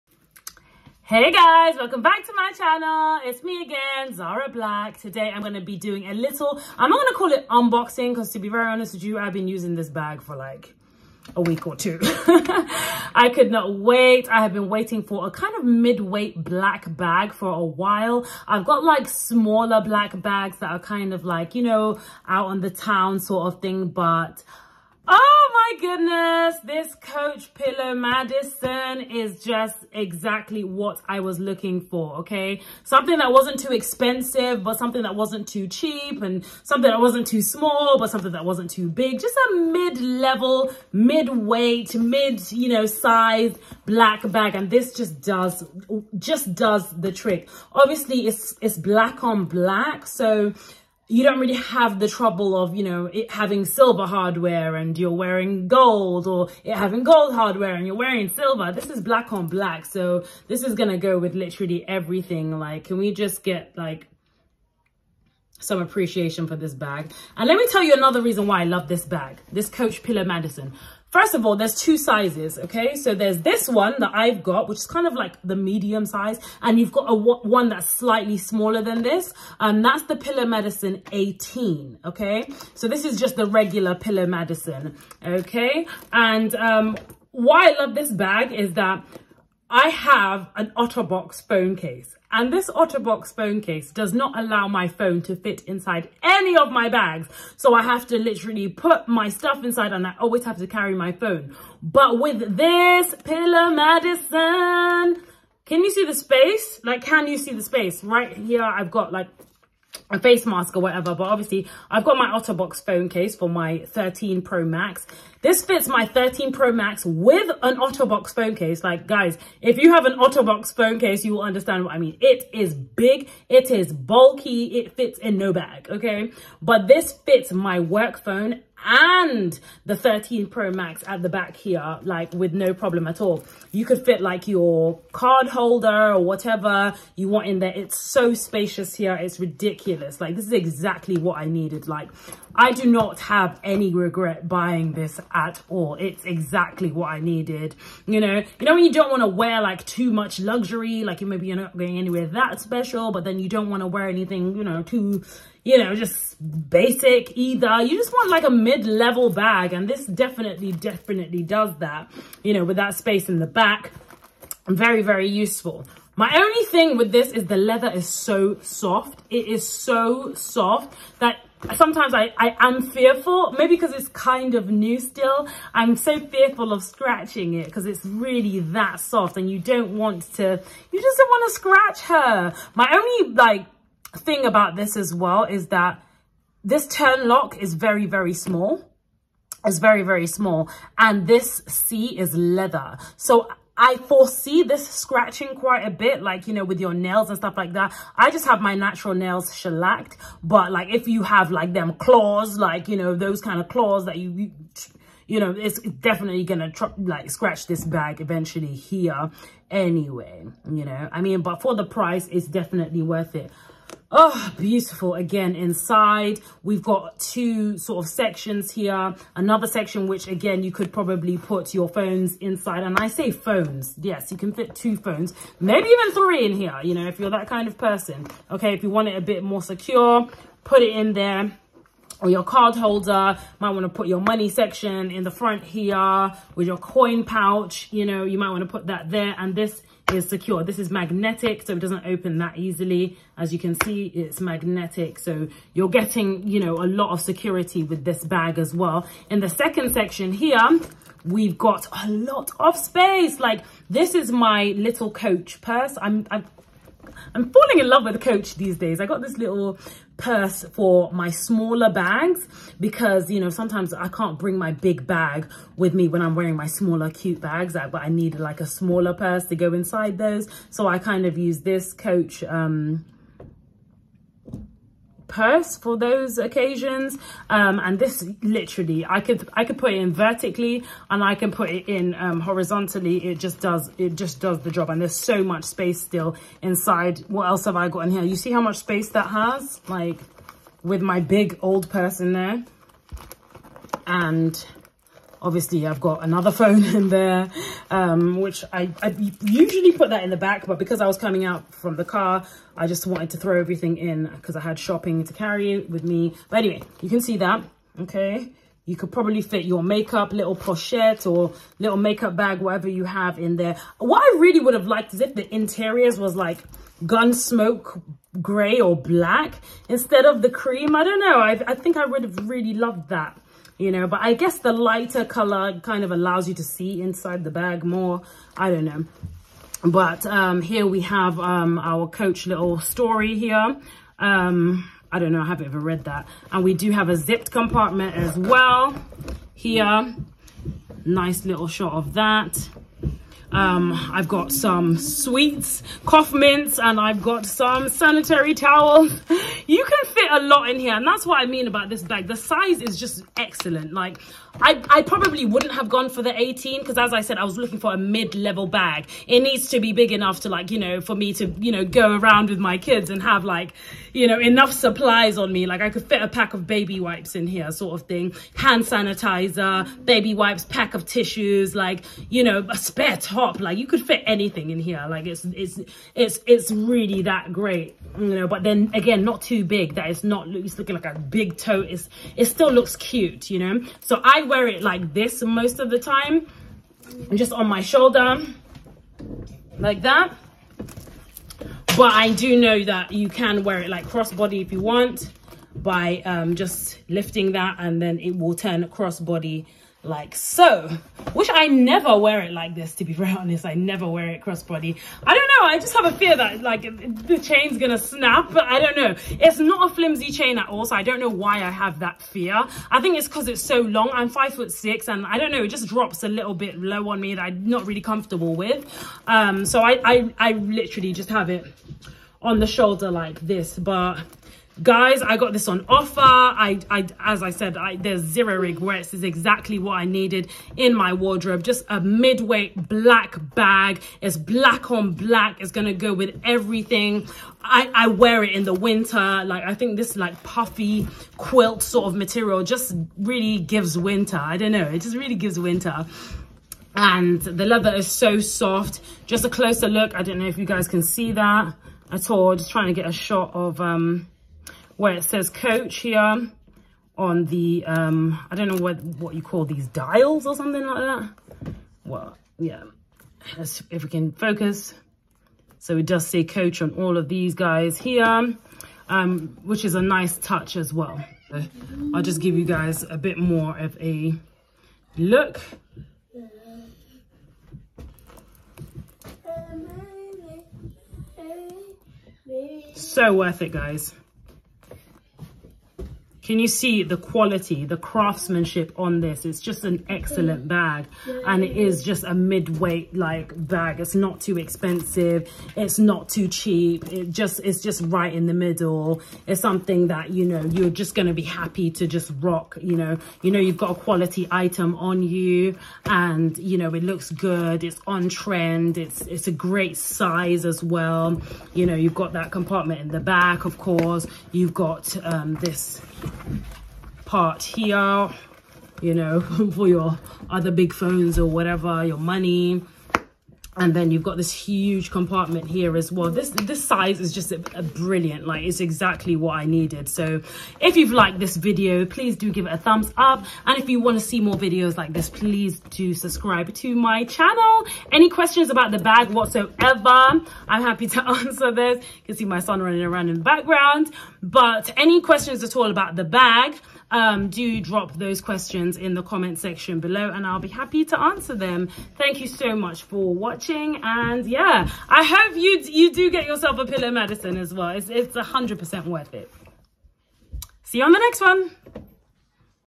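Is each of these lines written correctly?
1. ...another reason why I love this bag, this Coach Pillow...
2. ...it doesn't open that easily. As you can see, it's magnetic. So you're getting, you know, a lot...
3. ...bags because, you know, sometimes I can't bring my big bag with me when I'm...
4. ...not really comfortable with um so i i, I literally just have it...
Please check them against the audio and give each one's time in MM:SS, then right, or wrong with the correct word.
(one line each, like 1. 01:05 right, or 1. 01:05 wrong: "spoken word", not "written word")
1. 01:07 right
2. 04:01 right
3. 04:21 right
4. 06:57 right.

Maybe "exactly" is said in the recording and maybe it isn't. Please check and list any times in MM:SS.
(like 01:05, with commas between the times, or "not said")
00:29, 02:20, 02:26, 07:09, 08:48.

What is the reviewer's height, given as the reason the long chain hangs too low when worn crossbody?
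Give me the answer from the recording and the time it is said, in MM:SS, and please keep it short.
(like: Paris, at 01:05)
5 foot 6, at 06:54.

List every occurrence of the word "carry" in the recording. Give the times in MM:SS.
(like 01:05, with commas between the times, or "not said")
01:40, 05:05.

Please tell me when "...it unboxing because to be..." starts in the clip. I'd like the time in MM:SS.
00:07.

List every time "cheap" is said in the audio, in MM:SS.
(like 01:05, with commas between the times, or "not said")
00:35, 08:16.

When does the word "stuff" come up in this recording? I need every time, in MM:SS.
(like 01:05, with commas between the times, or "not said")
01:39, 03:17.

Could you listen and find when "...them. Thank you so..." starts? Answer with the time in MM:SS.
09:11.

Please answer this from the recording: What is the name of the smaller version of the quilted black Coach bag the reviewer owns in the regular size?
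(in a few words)
Pillow Madison 18.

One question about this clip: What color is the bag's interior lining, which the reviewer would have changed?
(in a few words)
cream.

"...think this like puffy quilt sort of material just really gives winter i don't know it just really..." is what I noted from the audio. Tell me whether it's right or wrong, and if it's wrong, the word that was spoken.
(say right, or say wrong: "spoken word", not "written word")
right.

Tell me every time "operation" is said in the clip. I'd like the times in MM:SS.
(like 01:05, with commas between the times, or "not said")
not said.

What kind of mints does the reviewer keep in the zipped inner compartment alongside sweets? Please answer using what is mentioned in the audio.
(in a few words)
cough mints.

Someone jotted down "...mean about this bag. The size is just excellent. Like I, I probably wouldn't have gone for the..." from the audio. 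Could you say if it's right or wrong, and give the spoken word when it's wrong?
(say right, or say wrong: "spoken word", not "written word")
right.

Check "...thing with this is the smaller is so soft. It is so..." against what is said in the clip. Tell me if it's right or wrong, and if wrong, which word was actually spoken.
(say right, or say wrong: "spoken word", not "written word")
wrong: "leather", not "smaller".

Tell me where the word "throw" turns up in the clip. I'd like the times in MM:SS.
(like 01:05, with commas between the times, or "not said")
05:03.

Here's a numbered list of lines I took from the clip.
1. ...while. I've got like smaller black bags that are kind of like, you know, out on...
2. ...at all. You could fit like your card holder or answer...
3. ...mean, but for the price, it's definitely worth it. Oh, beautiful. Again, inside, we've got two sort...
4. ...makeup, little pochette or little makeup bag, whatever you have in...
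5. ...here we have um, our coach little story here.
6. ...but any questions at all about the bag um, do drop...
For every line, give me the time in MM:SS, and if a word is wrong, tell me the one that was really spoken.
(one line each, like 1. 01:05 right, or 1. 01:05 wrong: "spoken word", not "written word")
1. 00:17 right
2. 02:13 wrong: "whatever", not "answer"
3. 03:31 right
4. 05:09 right
5. 05:30 right
6. 09:04 right.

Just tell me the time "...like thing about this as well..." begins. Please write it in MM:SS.
03:03.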